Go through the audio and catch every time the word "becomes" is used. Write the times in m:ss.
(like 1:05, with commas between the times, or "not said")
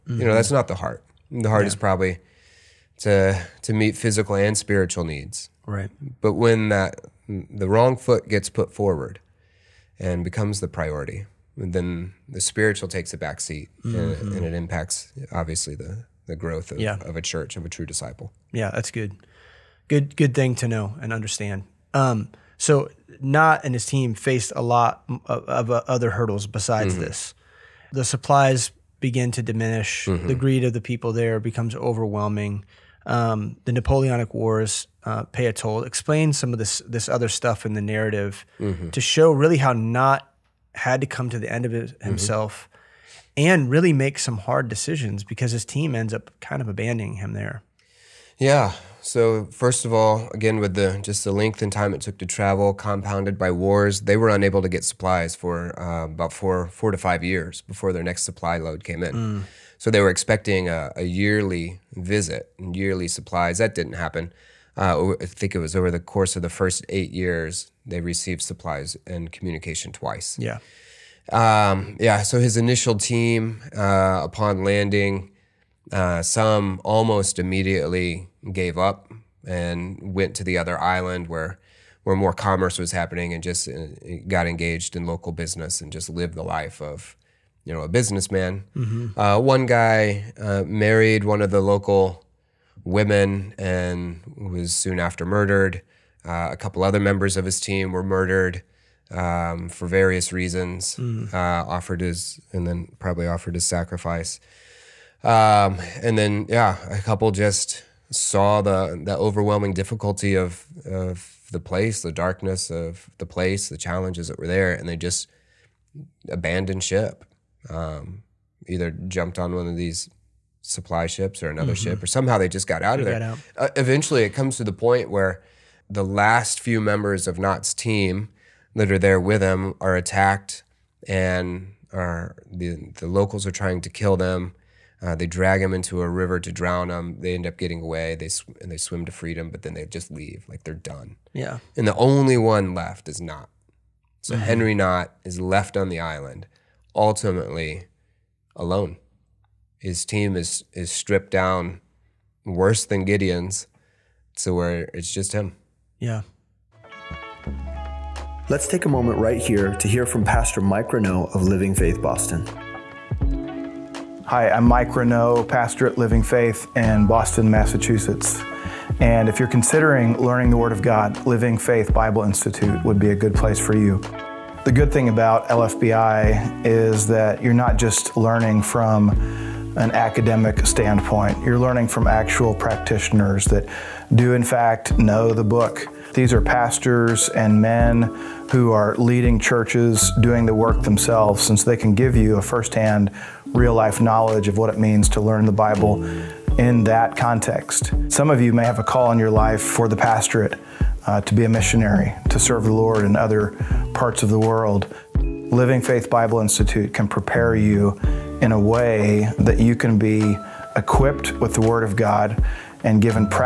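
0:10, 0:31.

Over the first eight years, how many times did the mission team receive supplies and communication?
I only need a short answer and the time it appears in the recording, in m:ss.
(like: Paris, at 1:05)
2, at 1:09.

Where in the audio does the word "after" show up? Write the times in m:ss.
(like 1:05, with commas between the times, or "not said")
1:34.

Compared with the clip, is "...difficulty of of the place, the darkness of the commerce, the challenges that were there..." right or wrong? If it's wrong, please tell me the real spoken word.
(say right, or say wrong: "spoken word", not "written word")
wrong: "place", not "commerce".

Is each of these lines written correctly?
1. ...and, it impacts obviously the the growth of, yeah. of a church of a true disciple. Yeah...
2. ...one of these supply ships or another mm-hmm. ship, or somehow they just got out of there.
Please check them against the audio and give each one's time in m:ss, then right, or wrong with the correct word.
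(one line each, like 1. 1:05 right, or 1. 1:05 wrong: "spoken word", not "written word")
1. 0:14 right
2. 1:59 right.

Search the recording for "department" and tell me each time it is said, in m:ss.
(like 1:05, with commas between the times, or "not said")
not said.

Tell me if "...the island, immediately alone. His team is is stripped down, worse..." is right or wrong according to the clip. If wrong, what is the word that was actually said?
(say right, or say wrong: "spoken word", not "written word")
wrong: "ultimately", not "immediately".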